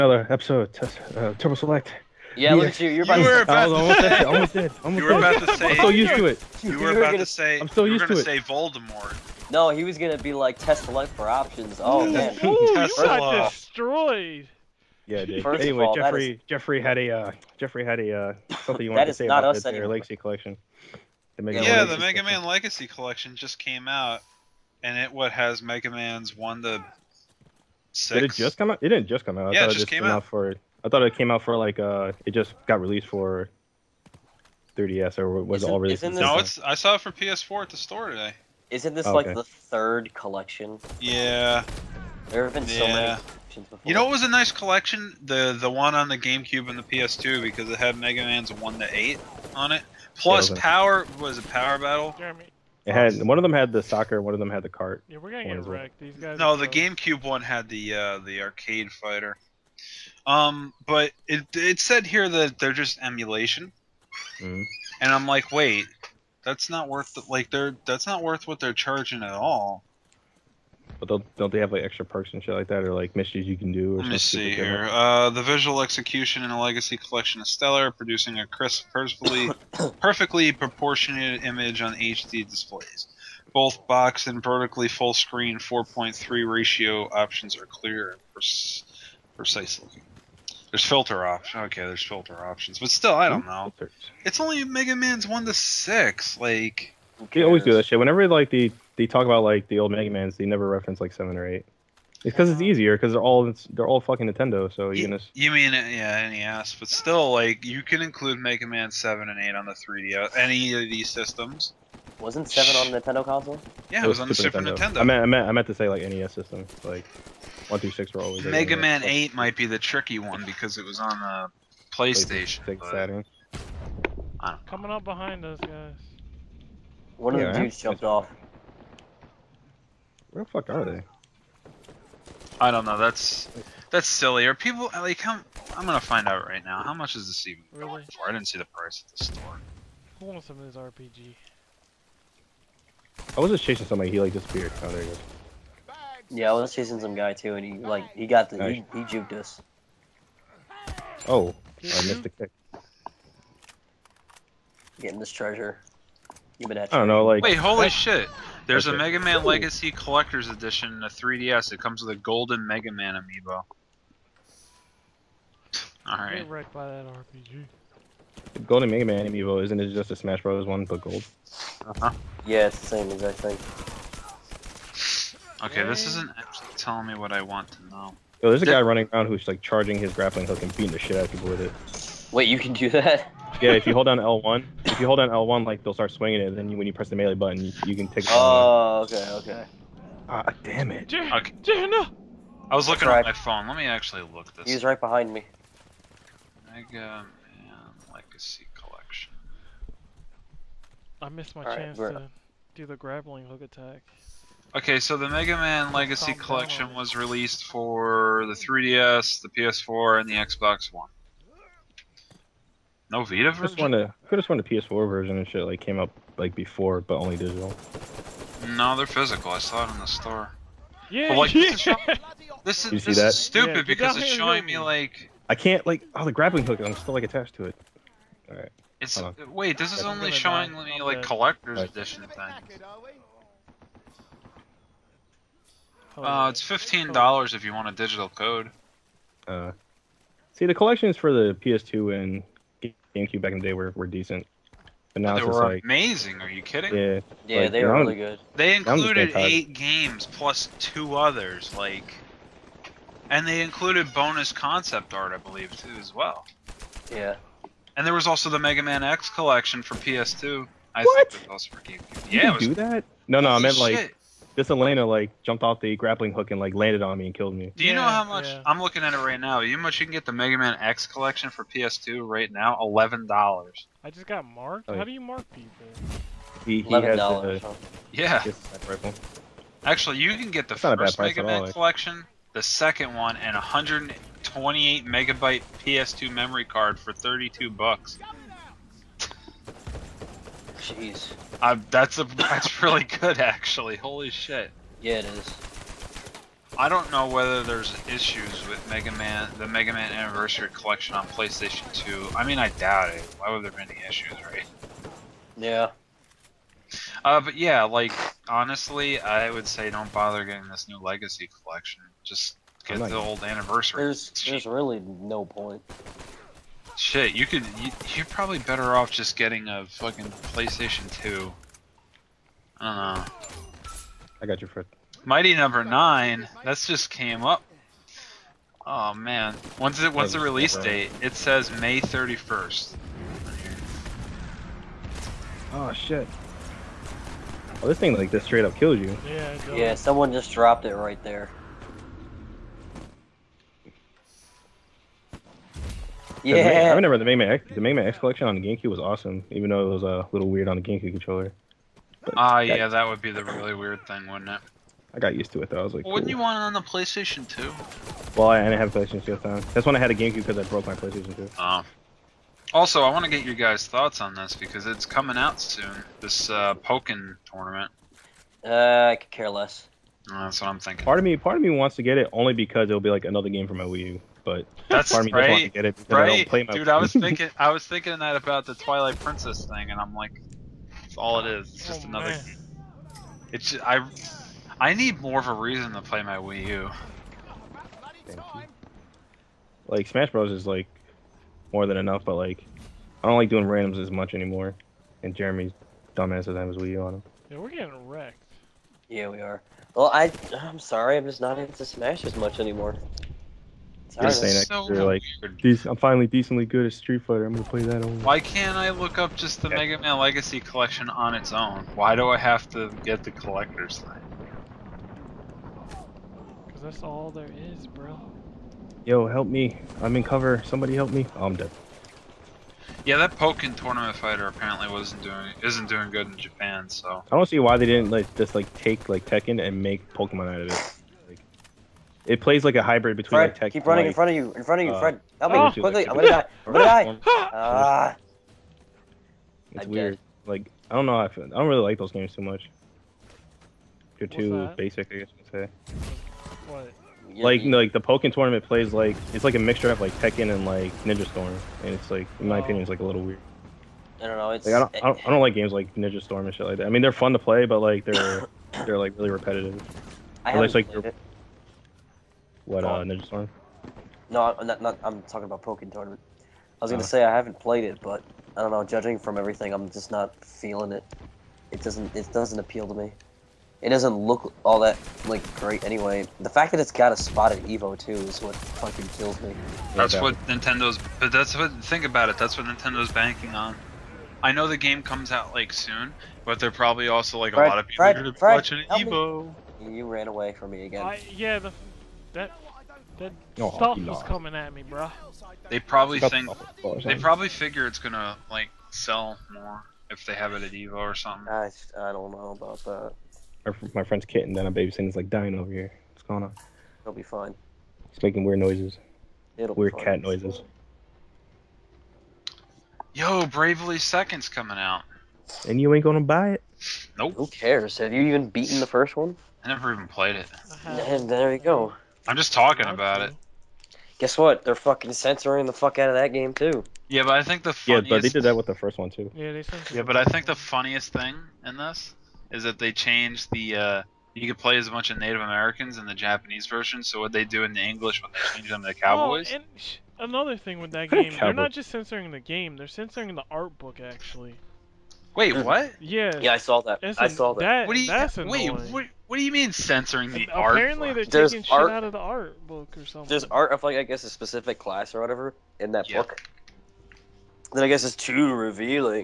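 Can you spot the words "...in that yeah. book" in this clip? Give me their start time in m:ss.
9:15.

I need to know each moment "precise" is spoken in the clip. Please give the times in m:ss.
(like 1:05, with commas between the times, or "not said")
1:29.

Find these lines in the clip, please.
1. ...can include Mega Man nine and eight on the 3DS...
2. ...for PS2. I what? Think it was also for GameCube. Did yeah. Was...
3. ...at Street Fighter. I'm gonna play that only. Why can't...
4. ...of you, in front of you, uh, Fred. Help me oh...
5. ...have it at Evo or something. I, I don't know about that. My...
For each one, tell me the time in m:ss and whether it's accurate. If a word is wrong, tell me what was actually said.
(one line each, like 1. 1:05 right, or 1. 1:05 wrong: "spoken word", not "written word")
1. 1:47 wrong: "seven", not "nine"
2. 4:19 right
3. 6:46 right
4. 7:14 right
5. 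8:20 right.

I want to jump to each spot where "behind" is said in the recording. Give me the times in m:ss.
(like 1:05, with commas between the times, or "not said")
2:05, 3:15.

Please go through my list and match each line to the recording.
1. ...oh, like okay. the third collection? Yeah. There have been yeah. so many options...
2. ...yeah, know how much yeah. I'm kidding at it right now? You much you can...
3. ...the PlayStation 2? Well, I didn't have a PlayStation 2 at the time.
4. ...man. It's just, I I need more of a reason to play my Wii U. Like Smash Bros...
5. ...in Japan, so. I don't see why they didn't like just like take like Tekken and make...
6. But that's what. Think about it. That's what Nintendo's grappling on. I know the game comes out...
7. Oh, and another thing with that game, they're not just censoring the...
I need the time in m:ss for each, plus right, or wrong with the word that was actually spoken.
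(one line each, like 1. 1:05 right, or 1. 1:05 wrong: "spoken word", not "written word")
1. 0:39 wrong: "collections", not "options"
2. 4:27 wrong: "looking", not "kidding"
3. 5:56 right
4. 6:22 right
5. 7:06 right
6. 8:01 wrong: "banking", not "grappling"
7. 8:59 right.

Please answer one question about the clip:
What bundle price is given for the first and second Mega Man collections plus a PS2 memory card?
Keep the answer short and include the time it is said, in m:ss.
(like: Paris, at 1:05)
$32, at 4:47.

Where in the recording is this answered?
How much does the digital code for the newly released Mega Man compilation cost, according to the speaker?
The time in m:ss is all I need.
3:56.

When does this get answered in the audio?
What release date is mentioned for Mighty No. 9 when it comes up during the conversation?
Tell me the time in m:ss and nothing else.
5:31.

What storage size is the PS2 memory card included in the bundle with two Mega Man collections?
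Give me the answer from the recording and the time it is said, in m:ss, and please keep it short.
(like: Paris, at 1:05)
128 megabytes, at 4:43.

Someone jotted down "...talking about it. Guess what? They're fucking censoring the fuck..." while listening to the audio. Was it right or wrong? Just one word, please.
right.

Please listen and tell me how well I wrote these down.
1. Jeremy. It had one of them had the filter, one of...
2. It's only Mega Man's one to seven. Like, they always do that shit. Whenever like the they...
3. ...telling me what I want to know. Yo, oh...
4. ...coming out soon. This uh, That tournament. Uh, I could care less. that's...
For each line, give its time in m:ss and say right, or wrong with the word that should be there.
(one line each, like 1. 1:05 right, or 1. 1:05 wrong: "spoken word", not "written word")
1. 0:52 wrong: "soccer", not "filter"
2. 1:34 wrong: "six", not "seven"
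3. 2:56 right
4. 6:05 wrong: "Pokken", not "That".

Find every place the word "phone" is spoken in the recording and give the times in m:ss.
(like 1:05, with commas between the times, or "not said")
3:13.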